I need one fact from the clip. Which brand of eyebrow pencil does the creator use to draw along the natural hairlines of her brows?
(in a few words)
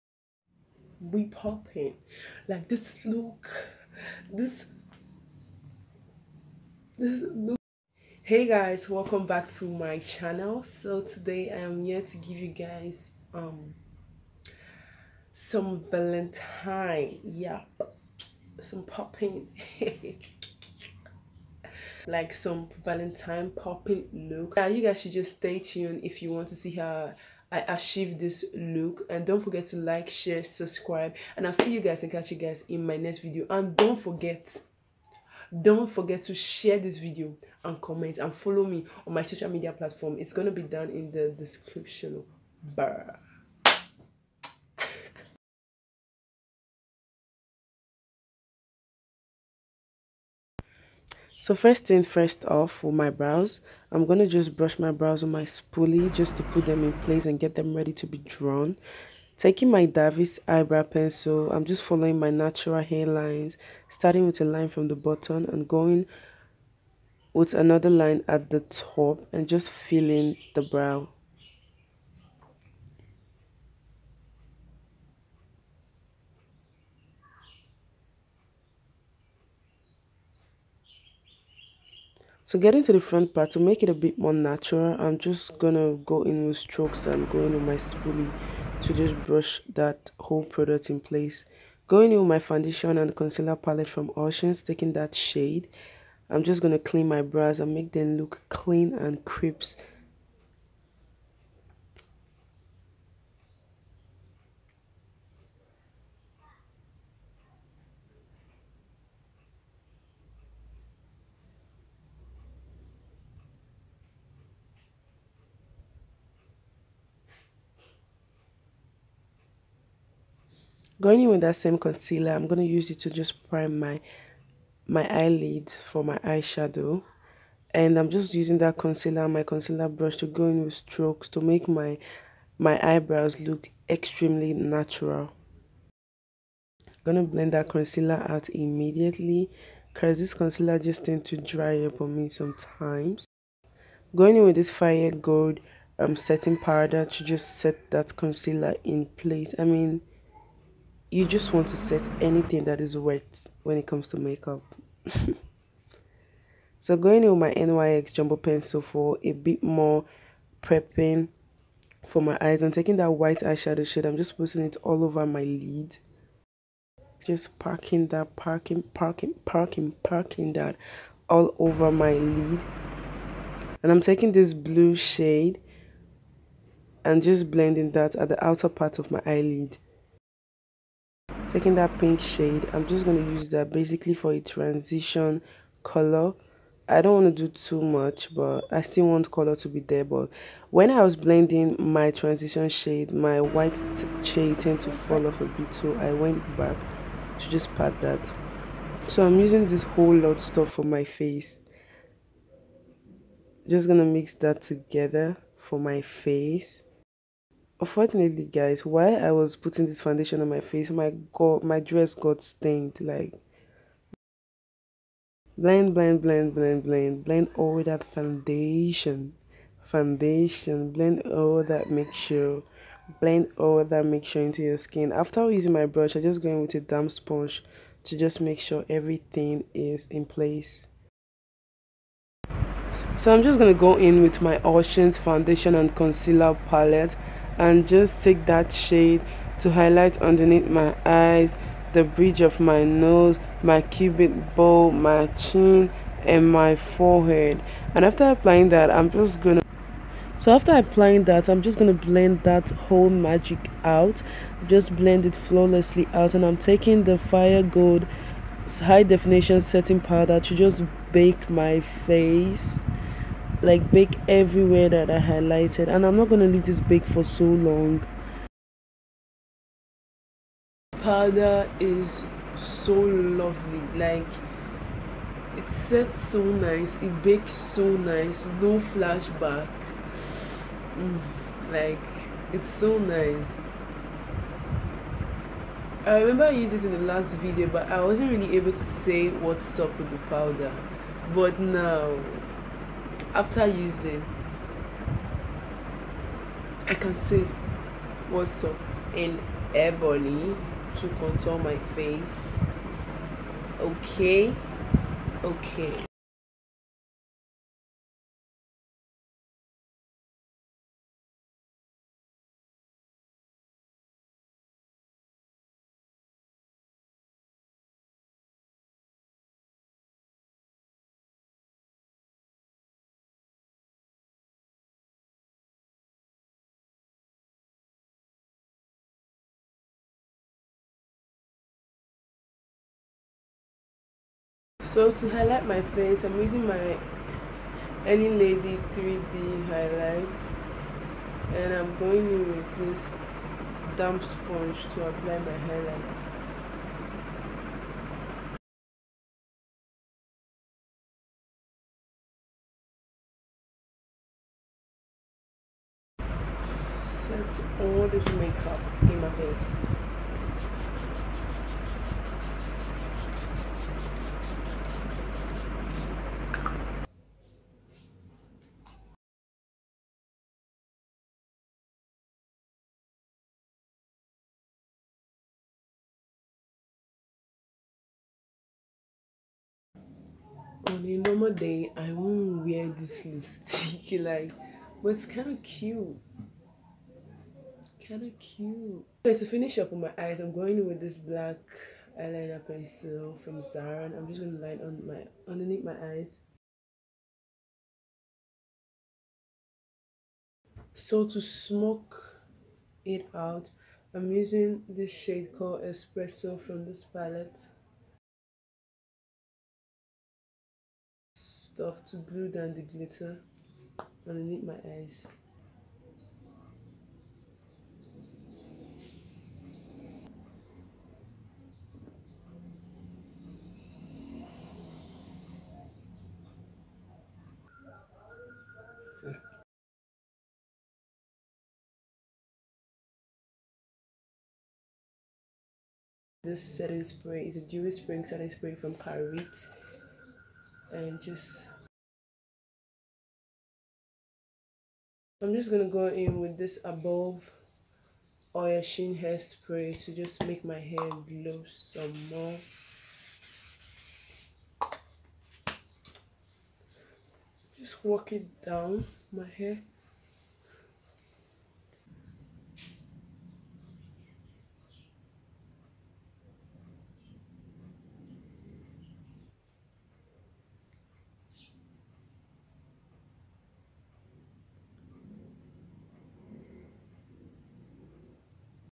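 Davis.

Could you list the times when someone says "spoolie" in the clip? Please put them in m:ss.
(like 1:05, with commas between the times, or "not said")
0:55, 1:27.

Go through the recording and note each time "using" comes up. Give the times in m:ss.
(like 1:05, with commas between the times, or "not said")
2:08, 3:19, 3:45, 4:53, 5:36, 6:44.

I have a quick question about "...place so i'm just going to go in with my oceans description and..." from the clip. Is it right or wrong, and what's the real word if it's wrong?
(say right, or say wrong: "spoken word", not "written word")
wrong: "foundation", not "description".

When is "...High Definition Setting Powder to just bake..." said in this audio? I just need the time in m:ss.
4:18.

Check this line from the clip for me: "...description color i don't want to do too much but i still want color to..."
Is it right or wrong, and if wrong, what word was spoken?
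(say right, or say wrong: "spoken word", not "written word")
wrong: "transition", not "description".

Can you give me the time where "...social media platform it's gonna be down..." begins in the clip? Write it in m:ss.
0:39.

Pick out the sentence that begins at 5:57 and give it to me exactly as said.
Set all this makeup in my face.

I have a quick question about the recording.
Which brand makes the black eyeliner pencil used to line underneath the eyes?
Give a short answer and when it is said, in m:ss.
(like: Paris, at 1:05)
Zara, at 6:33.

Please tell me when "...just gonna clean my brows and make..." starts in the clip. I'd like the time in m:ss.
1:36.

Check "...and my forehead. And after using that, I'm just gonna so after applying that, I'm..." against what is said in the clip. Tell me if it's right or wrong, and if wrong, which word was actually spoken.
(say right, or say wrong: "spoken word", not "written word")
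wrong: "applying", not "using".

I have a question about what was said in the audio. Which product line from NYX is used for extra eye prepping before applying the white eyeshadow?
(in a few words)
Jumbo Pencil.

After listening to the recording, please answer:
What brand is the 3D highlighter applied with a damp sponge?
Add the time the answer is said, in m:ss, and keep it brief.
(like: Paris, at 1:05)
Any Lady, at 5:38.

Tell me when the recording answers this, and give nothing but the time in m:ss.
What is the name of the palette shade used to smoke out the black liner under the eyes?
6:45.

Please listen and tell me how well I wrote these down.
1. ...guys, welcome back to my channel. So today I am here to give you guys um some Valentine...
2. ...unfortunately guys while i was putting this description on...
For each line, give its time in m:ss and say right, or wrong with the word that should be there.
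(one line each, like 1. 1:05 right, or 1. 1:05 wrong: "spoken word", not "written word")
1. 0:08 right
2. 3:27 wrong: "foundation", not "description".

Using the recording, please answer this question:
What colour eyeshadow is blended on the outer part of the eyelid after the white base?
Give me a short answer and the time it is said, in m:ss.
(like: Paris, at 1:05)
Blue, at 2:54.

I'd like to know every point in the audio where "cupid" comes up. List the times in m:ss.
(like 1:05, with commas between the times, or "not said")
4:03.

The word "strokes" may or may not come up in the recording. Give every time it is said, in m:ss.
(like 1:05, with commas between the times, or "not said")
1:26, 2:10.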